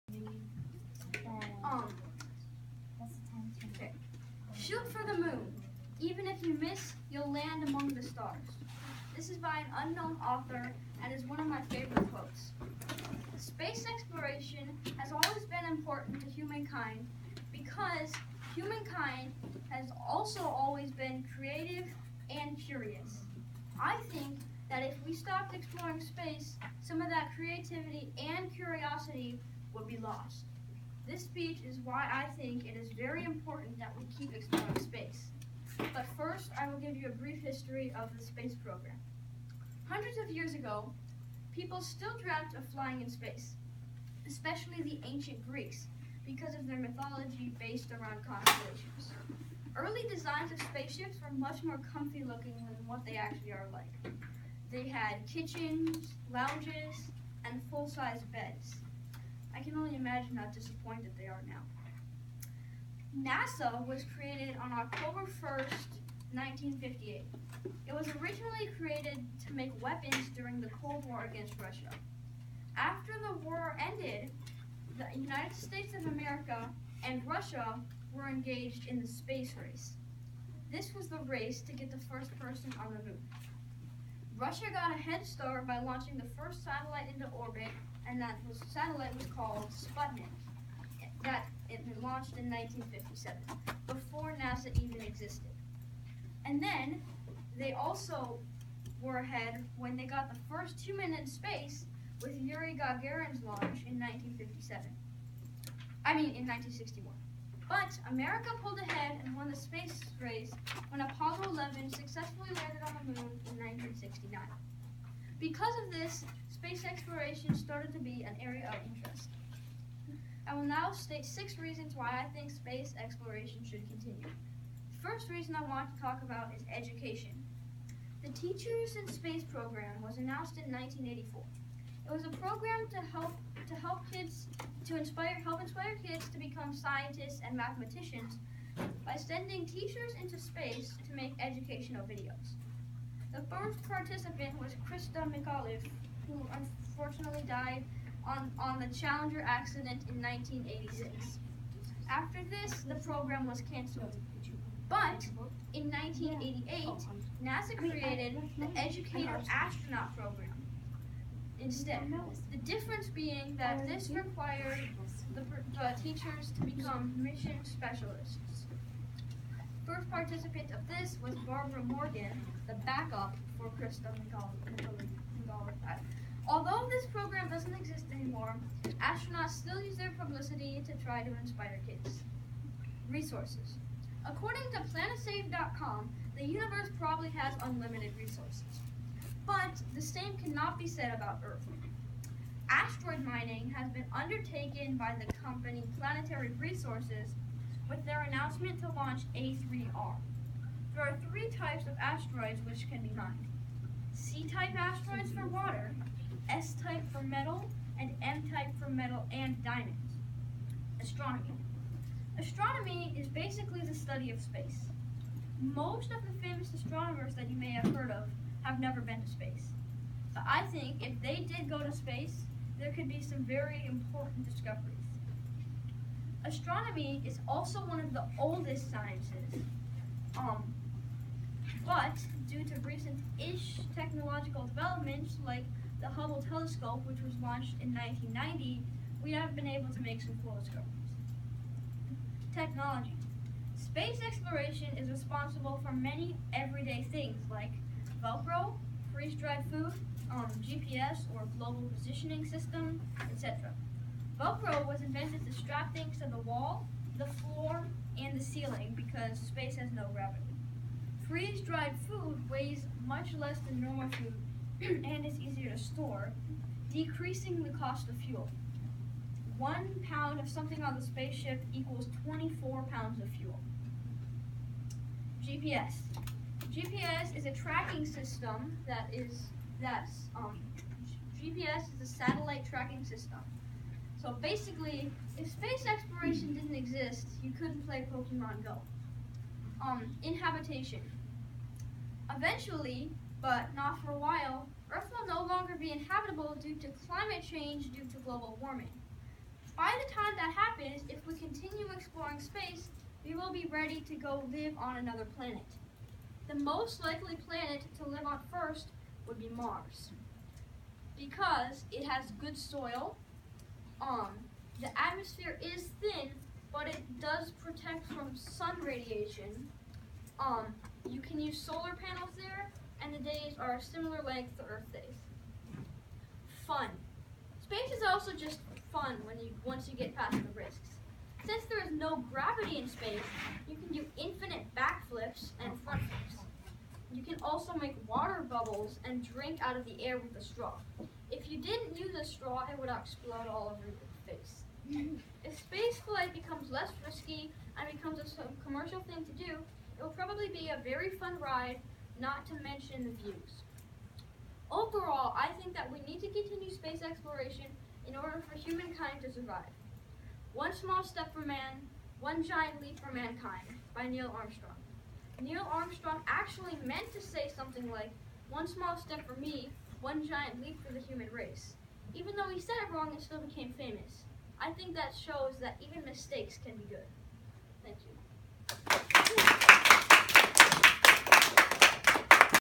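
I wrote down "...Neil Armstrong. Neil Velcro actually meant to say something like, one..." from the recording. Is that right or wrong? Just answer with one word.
wrong.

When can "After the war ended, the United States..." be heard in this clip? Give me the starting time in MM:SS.
01:12.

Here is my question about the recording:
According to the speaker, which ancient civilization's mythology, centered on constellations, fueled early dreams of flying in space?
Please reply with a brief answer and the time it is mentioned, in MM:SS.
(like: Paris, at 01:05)
ancient Greeks, at 00:45.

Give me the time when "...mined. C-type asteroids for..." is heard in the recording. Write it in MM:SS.
03:23.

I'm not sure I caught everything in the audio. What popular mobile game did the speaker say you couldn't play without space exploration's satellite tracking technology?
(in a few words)
Pokemon Go.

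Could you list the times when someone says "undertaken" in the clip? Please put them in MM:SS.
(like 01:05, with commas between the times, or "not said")
03:14.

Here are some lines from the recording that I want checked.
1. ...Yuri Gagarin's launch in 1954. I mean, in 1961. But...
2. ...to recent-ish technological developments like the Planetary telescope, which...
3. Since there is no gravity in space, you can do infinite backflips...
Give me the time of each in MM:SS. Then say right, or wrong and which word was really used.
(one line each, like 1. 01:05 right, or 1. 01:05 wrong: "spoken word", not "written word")
1. 01:42 wrong: "1957", not "1954"
2. 03:52 wrong: "Hubble", not "Planetary"
3. 05:31 right.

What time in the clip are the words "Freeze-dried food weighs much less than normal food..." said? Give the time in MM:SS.
04:21.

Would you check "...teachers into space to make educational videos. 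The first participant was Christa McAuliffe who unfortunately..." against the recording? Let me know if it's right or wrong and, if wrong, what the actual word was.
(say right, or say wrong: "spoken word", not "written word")
right.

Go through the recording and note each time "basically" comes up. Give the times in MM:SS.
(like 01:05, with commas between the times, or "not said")
03:33, 04:44.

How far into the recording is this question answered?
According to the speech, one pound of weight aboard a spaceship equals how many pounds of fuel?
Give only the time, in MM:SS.
04:32.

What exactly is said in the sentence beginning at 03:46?
Astronomy is also one of the oldest sciences.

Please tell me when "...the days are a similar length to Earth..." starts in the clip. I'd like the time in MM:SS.
05:23.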